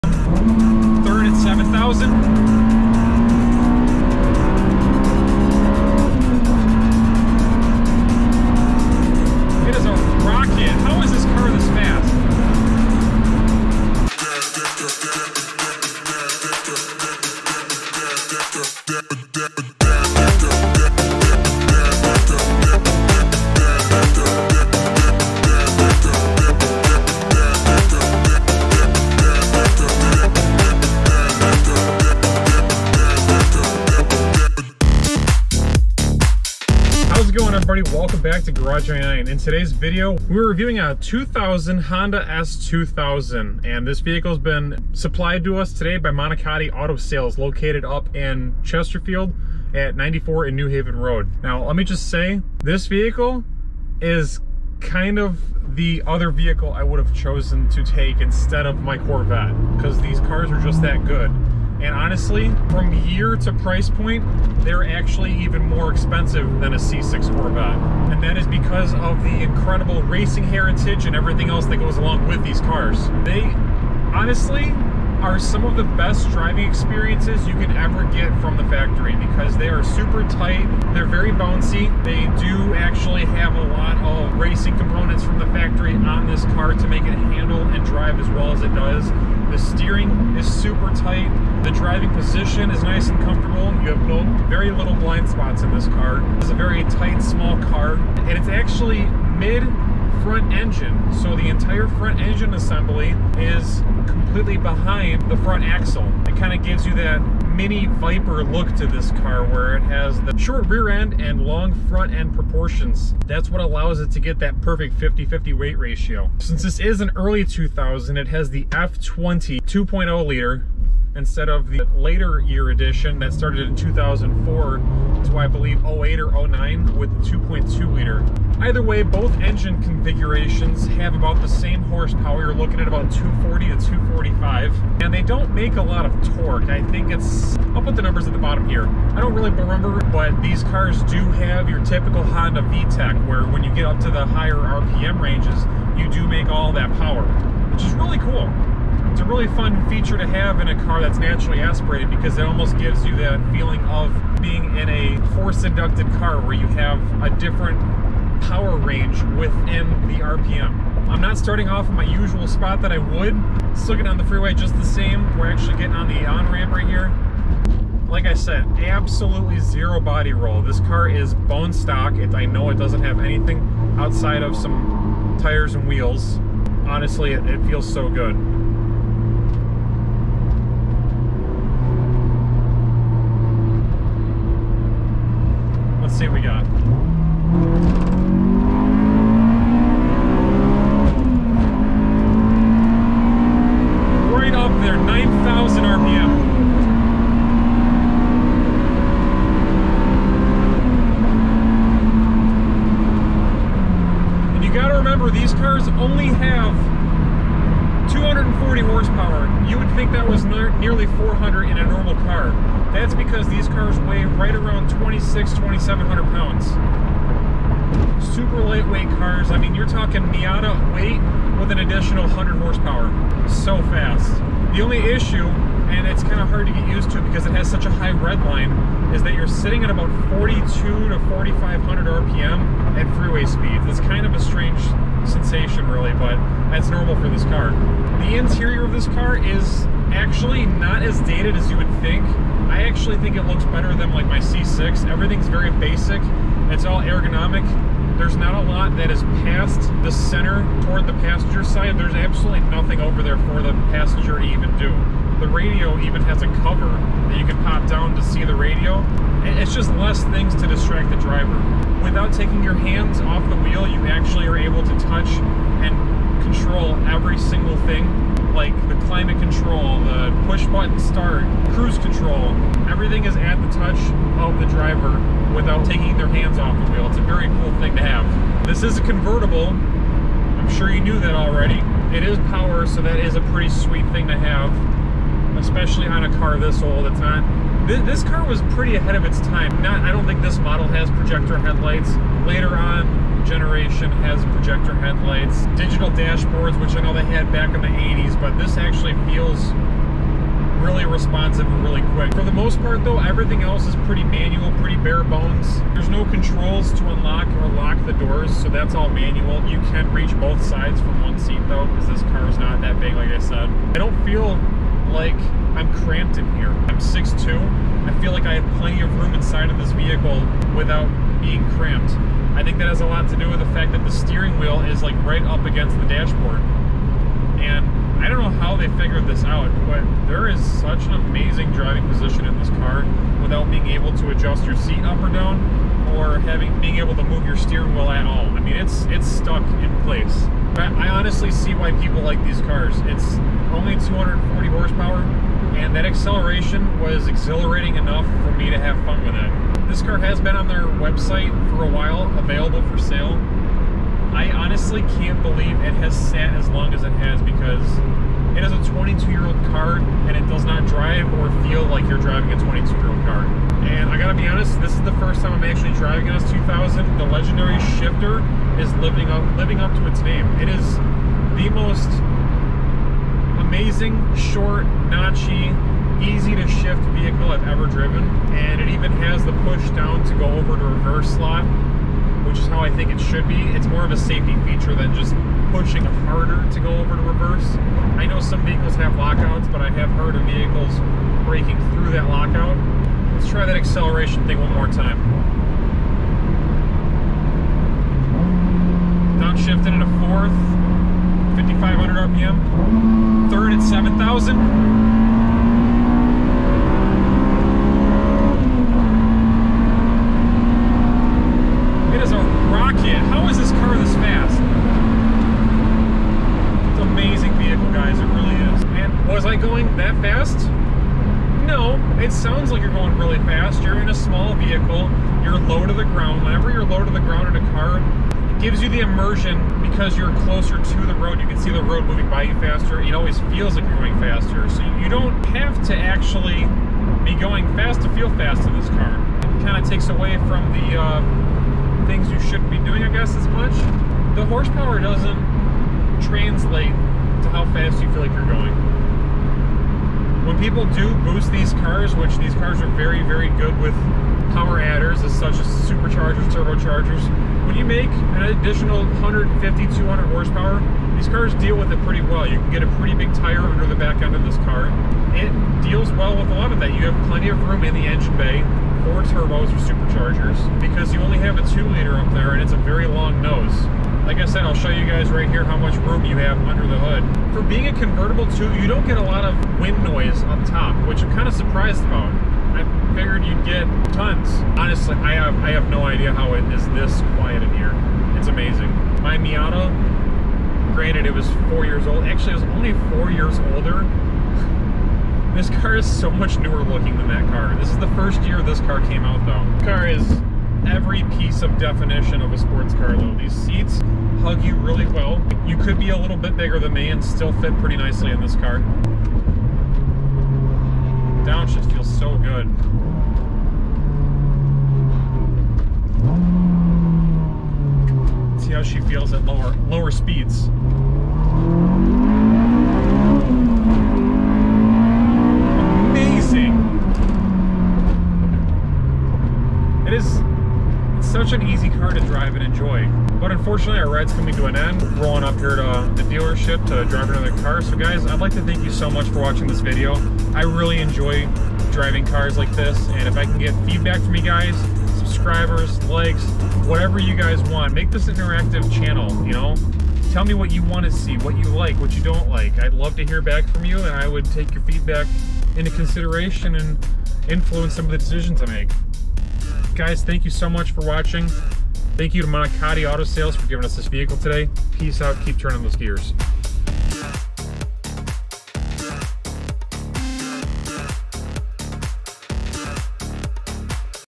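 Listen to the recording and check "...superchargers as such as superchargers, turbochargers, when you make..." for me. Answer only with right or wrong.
wrong.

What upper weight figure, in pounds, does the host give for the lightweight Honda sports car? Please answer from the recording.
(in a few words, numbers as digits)
2700.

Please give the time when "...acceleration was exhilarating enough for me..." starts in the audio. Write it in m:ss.
5:46.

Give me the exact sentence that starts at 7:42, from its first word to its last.
You can get a pretty big tire under the back end of this car.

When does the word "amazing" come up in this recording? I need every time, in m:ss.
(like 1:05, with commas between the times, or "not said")
5:31, 6:13, 6:57, 8:08.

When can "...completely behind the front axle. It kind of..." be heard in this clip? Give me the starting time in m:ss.
1:44.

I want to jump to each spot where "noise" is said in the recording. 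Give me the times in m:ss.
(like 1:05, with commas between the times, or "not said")
8:00.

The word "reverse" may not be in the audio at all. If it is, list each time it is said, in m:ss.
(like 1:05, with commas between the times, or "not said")
6:20, 6:27.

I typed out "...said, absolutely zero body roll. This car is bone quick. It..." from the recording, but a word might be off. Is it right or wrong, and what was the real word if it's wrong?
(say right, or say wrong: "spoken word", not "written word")
wrong: "stock", not "quick".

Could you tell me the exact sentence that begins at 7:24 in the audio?
The horsepower doesn't translate to how fast you feel like you're going.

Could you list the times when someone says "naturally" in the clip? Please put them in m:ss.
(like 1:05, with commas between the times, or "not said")
2:31.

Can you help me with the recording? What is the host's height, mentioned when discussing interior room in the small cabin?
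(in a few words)
6'2".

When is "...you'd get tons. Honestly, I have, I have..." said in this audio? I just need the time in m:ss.
8:03.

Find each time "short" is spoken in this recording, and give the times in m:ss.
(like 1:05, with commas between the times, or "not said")
1:50, 6:14.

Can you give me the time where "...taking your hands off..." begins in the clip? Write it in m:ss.
4:22.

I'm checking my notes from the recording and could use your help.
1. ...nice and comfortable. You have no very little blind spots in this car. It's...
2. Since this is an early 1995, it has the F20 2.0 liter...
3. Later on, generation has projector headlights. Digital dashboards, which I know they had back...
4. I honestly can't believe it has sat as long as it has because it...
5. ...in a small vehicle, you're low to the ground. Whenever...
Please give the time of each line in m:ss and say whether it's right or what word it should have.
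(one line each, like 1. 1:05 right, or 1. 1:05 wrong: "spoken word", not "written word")
1. 1:32 right
2. 1:56 wrong: "2000", not "1995"
3. 4:52 right
4. 5:54 right
5. 7:03 right.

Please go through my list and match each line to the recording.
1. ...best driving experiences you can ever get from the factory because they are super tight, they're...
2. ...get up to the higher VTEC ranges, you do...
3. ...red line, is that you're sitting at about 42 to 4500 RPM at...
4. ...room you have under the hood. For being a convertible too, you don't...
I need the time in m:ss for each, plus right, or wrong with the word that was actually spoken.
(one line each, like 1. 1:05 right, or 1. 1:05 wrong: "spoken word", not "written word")
1. 1:15 right
2. 2:23 wrong: "RPM", not "VTEC"
3. 3:48 right
4. 7:56 right.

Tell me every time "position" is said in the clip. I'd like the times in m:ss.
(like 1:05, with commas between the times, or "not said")
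1:32, 5:32.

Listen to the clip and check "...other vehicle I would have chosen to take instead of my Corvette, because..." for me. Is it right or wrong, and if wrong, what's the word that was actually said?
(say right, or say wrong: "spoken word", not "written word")
right.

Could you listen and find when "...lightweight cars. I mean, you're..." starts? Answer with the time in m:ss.
3:38.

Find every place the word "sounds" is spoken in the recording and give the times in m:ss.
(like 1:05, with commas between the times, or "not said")
7:02.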